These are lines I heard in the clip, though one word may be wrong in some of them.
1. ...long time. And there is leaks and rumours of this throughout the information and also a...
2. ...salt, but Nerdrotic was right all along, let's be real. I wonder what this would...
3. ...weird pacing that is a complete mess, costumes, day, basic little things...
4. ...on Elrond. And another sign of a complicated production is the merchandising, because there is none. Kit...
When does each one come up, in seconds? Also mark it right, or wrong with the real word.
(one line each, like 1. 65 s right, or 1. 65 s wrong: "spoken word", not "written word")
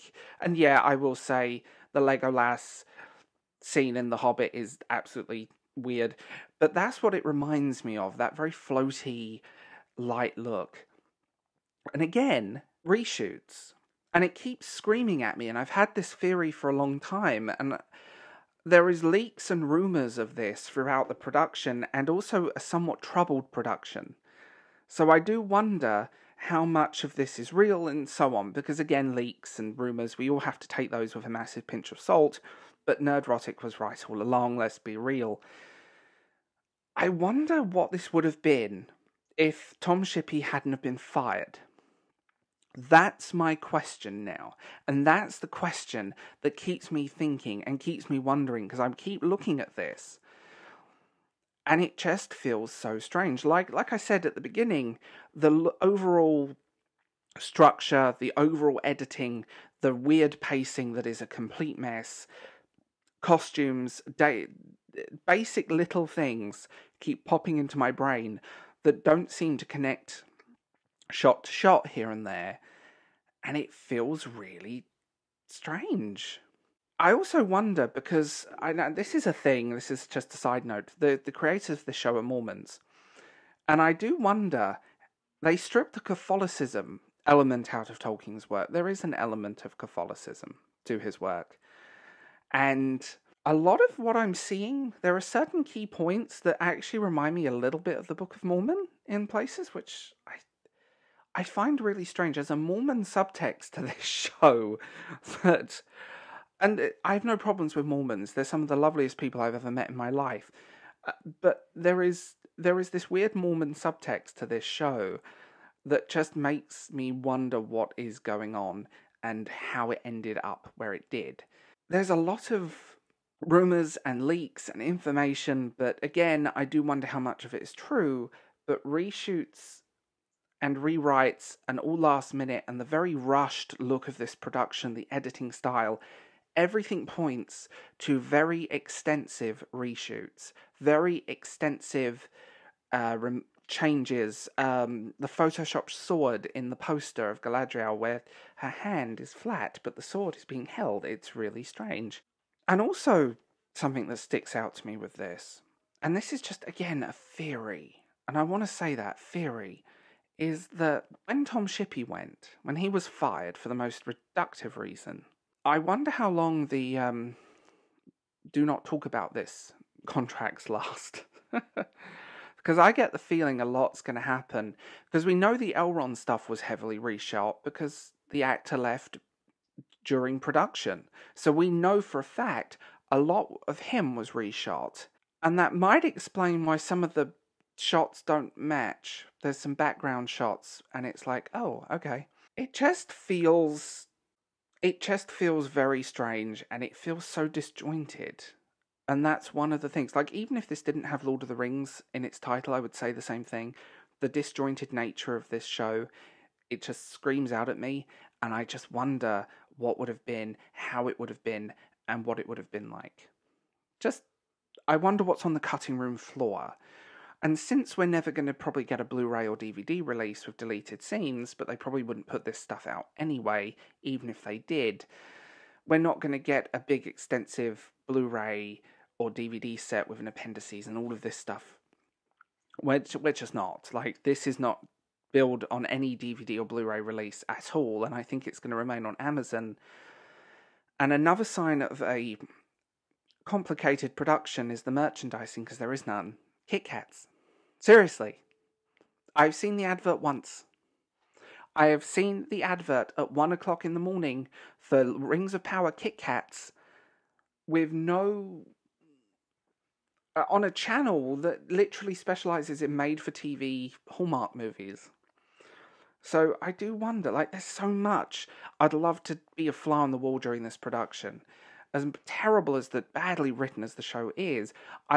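1. 16 s wrong: "production", not "information"
2. 31 s right
3. 59 s right
4. 239 s wrong: "Amazon", not "Elrond".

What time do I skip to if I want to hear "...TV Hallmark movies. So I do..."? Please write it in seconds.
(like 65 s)
263 s.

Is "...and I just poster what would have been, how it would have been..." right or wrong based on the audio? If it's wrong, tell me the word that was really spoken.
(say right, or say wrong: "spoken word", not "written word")
wrong: "wonder", not "poster".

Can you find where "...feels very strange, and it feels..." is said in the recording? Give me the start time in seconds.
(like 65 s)
195 s.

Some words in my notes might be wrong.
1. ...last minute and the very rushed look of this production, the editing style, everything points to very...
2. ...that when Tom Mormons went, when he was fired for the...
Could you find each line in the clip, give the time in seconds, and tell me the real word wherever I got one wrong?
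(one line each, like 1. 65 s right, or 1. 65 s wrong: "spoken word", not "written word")
1. 131 s right
2. 160 s wrong: "Shippey", not "Mormons".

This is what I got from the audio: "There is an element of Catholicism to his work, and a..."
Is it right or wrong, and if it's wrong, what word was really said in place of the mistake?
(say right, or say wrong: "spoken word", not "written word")
right.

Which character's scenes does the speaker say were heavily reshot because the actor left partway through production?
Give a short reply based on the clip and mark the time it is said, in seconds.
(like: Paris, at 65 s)
Elrond, at 175 s.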